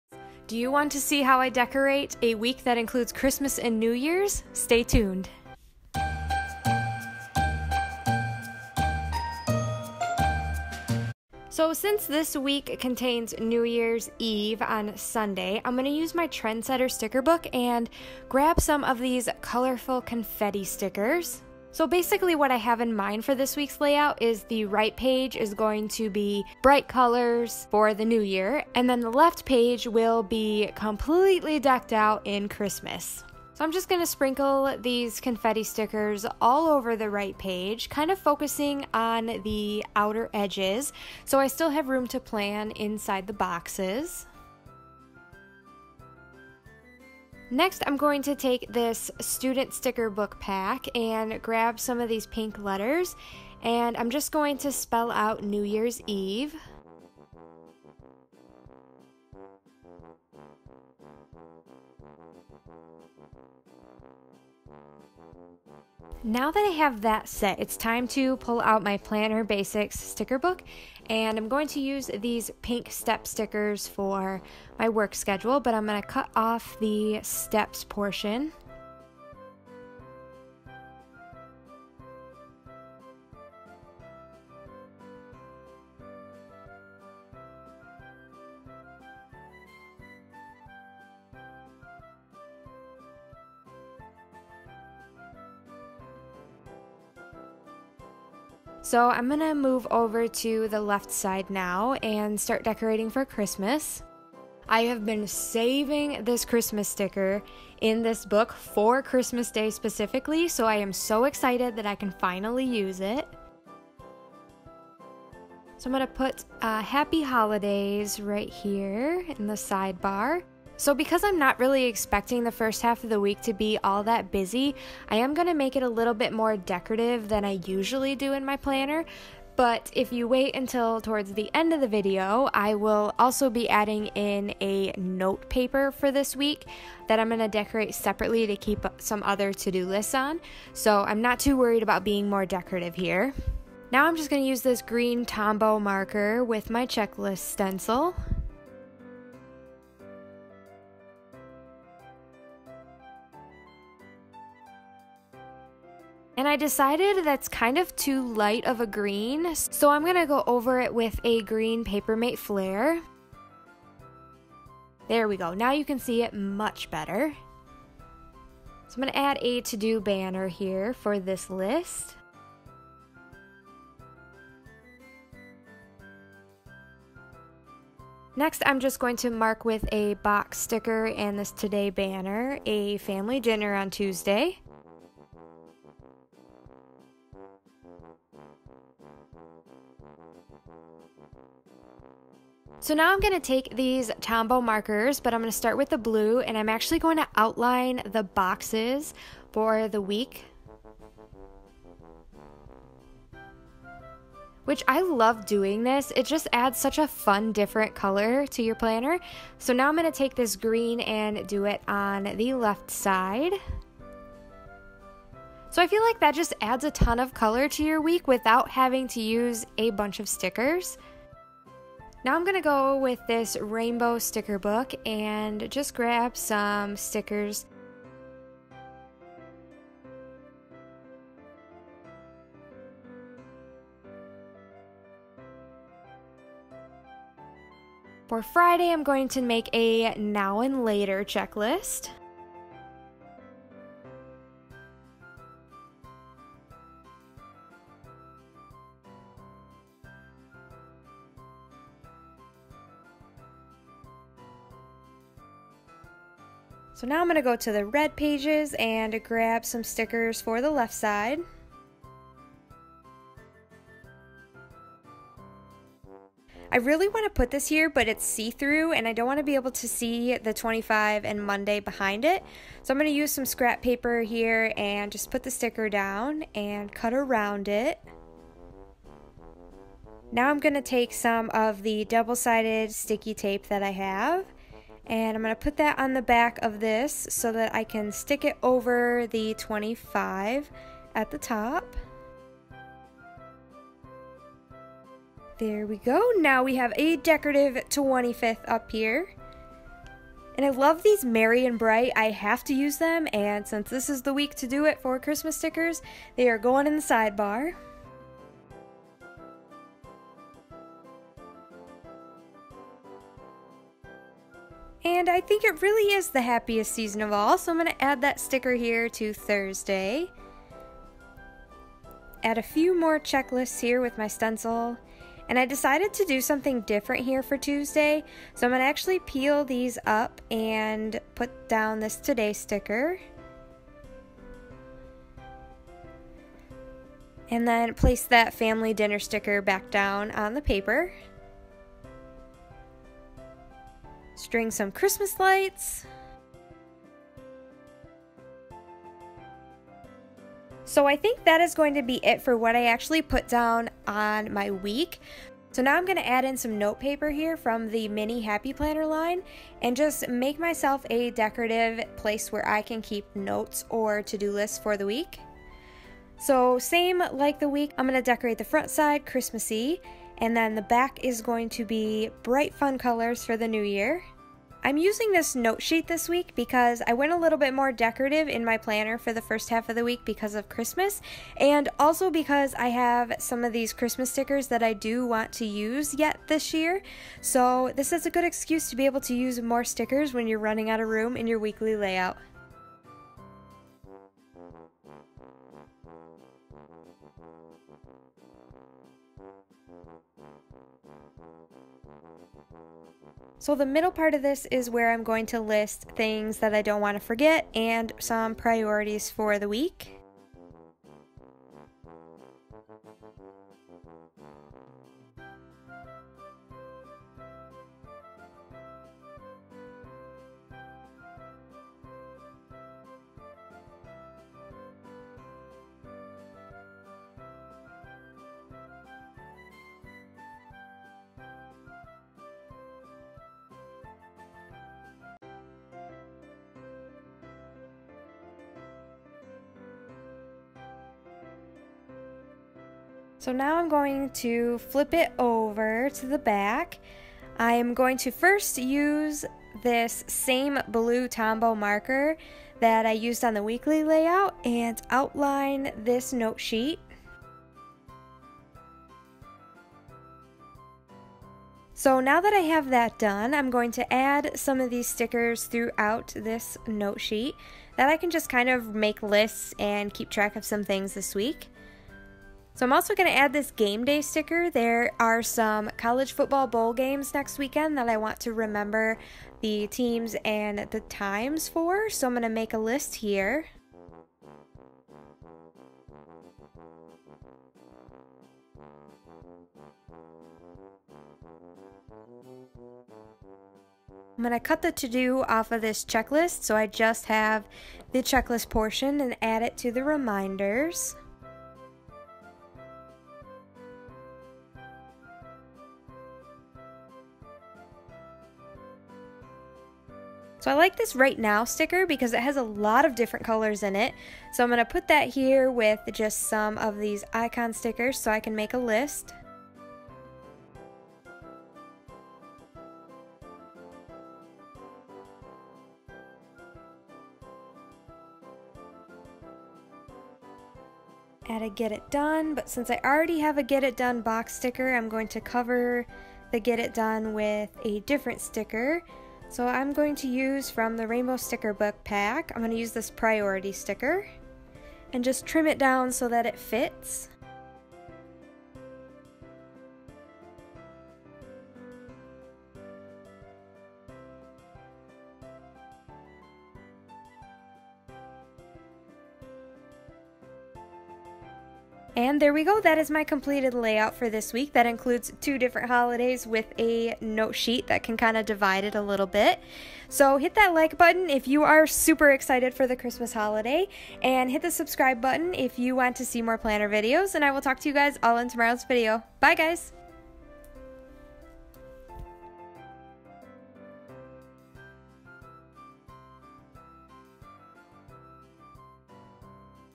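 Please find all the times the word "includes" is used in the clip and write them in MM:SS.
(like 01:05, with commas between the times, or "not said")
00:02, 09:24.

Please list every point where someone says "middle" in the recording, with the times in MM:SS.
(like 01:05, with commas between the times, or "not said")
06:43.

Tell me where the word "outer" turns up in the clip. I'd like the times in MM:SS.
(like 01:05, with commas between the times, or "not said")
00:39.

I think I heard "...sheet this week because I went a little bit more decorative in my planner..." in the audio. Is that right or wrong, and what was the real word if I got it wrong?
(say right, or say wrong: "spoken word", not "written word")
right.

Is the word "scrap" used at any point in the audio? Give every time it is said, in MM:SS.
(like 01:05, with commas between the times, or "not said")
04:33.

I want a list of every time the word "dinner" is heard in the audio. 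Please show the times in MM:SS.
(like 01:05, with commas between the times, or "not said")
03:03, 05:38.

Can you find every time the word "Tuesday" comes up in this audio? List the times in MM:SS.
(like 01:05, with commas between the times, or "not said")
03:03, 05:27.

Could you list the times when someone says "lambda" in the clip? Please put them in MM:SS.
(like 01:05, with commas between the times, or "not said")
not said.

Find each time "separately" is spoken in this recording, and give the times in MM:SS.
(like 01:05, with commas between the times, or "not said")
02:17.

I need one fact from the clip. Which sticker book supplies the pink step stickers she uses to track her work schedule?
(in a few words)
Planner Basics.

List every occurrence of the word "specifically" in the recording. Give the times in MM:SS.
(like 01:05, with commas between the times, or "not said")
01:49.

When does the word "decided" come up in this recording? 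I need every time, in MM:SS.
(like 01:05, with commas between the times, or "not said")
02:36, 05:25.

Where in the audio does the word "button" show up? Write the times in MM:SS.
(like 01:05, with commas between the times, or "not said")
09:30, 09:35.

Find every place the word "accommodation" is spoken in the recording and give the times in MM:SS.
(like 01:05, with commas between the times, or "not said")
not said.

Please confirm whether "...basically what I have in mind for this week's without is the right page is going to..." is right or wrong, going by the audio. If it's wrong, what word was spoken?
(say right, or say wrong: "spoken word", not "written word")
wrong: "layout", not "without".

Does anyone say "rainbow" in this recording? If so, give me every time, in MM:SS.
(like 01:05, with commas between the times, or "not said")
03:43, 09:01.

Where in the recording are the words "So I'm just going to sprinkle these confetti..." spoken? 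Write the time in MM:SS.
00:33.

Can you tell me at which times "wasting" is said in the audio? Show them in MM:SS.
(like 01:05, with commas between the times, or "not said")
not said.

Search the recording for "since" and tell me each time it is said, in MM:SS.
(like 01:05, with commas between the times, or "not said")
00:11, 05:03, 08:52.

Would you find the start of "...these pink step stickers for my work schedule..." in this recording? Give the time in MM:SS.
01:12.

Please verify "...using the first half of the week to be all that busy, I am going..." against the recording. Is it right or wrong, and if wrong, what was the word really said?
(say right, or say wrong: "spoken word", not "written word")
wrong: "expecting", not "using".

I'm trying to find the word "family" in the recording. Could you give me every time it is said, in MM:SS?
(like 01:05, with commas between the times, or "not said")
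03:02, 05:38.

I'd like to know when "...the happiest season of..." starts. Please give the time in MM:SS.
05:16.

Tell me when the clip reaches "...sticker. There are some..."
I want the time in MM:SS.
07:54.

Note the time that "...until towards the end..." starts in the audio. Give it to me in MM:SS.
02:10.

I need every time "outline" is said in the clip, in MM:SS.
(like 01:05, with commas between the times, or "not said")
03:17, 07:35.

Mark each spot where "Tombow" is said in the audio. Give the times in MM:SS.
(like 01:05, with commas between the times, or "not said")
02:25, 03:14, 07:31.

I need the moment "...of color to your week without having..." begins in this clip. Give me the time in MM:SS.
03:37.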